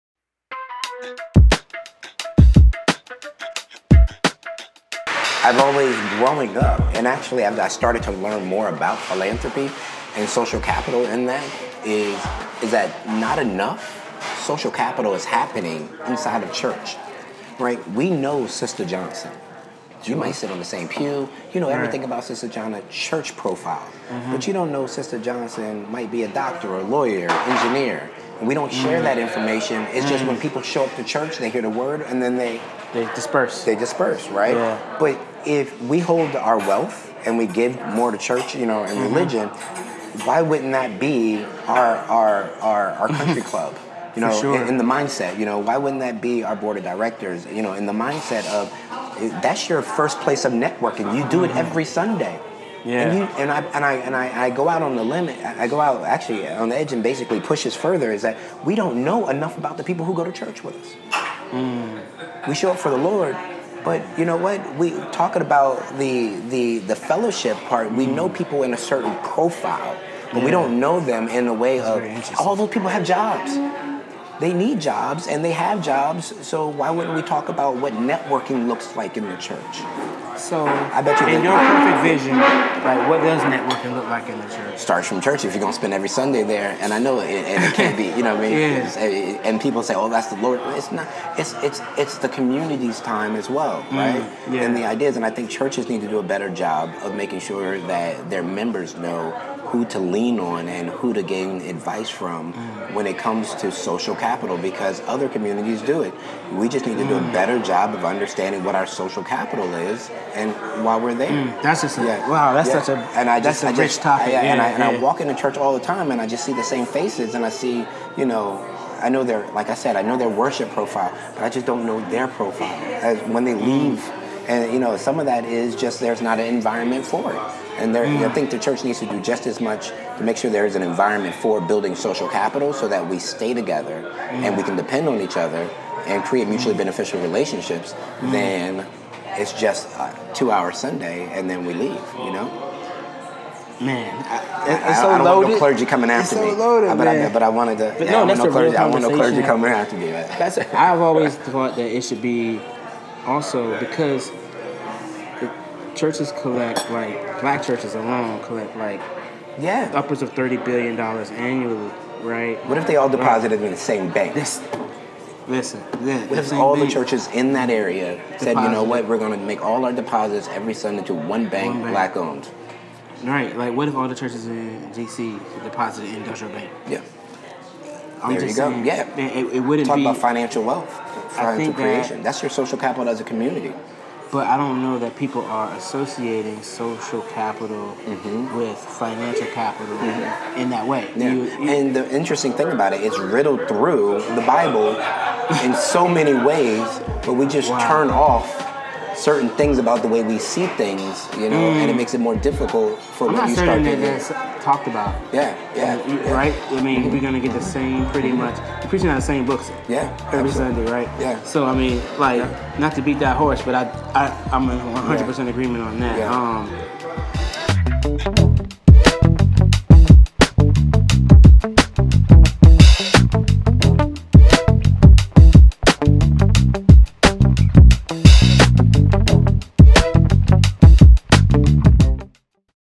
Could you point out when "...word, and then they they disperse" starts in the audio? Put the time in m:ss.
0:31.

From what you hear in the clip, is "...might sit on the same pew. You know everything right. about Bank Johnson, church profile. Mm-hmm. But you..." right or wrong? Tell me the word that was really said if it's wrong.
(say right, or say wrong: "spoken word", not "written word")
wrong: "Sister", not "Bank".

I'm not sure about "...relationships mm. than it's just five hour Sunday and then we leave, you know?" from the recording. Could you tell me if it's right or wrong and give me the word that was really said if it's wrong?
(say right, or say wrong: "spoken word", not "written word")
wrong: "two", not "five".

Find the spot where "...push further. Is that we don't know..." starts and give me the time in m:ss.
0:57.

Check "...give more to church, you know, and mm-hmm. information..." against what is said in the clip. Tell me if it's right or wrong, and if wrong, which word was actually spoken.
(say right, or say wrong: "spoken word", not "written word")
wrong: "religion", not "information".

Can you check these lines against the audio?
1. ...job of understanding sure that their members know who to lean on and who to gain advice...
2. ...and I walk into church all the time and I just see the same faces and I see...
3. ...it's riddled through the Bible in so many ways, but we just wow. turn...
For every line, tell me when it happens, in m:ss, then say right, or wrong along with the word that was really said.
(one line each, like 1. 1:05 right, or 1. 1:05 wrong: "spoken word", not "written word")
1. 1:36 wrong: "making", not "understanding"
2. 1:54 right
3. 3:13 right.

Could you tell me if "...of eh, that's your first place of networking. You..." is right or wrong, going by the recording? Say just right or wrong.
right.